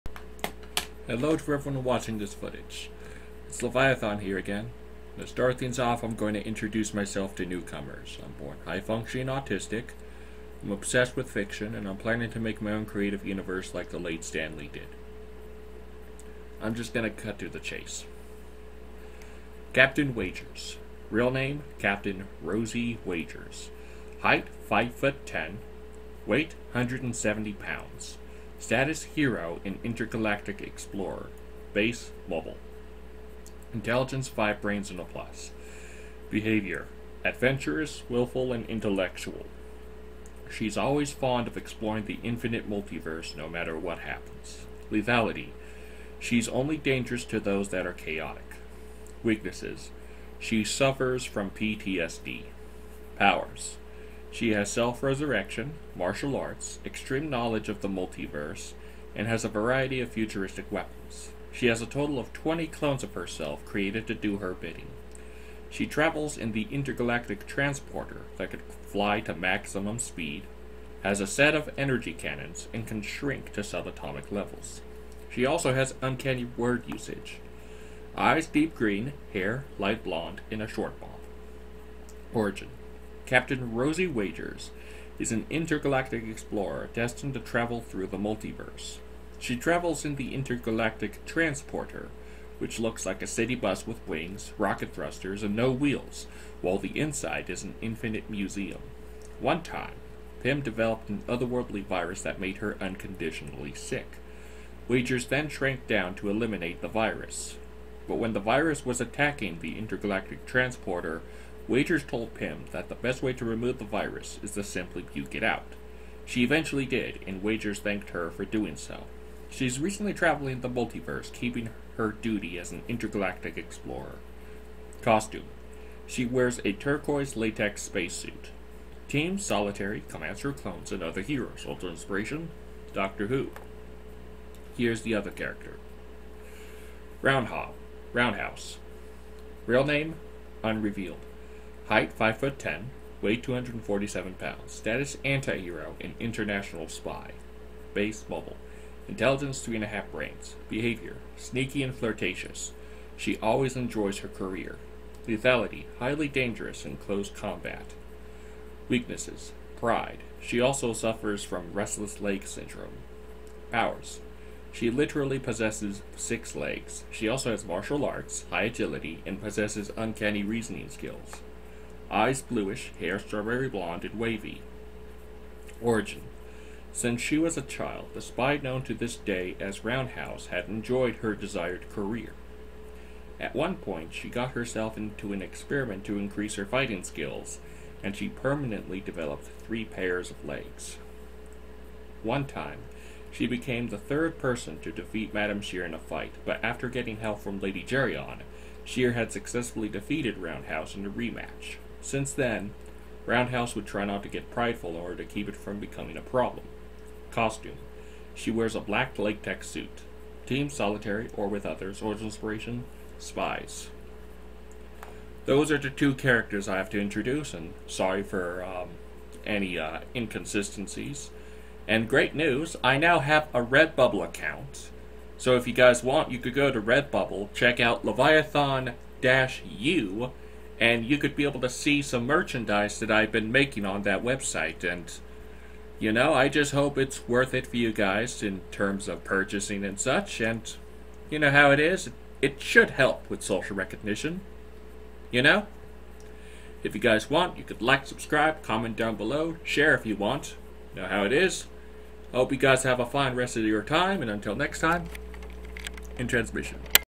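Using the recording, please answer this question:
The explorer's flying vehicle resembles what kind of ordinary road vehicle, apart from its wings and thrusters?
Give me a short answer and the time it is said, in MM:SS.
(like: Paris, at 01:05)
City bus, at 01:33.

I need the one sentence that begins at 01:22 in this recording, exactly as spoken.
Origin Captain Rosie Wagers is an intergalactic explorer destined to travel through the multiverse.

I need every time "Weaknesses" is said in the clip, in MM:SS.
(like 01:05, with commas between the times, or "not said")
00:49, 02:38.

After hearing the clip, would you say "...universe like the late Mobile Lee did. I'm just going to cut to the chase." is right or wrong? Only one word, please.
wrong.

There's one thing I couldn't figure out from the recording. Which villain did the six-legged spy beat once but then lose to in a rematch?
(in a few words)
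Madame Shear.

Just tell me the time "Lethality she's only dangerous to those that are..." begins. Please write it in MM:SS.
00:44.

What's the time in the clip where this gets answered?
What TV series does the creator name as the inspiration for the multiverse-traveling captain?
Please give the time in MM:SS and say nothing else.
02:12.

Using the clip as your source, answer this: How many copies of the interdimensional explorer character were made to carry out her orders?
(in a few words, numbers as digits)
20.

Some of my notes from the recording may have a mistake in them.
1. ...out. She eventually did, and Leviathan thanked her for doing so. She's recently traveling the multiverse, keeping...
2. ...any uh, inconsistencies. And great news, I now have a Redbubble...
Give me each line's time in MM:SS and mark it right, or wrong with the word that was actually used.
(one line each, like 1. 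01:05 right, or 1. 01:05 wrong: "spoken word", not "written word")
1. 01:55 wrong: "Wagers", not "Leviathan"
2. 03:39 right.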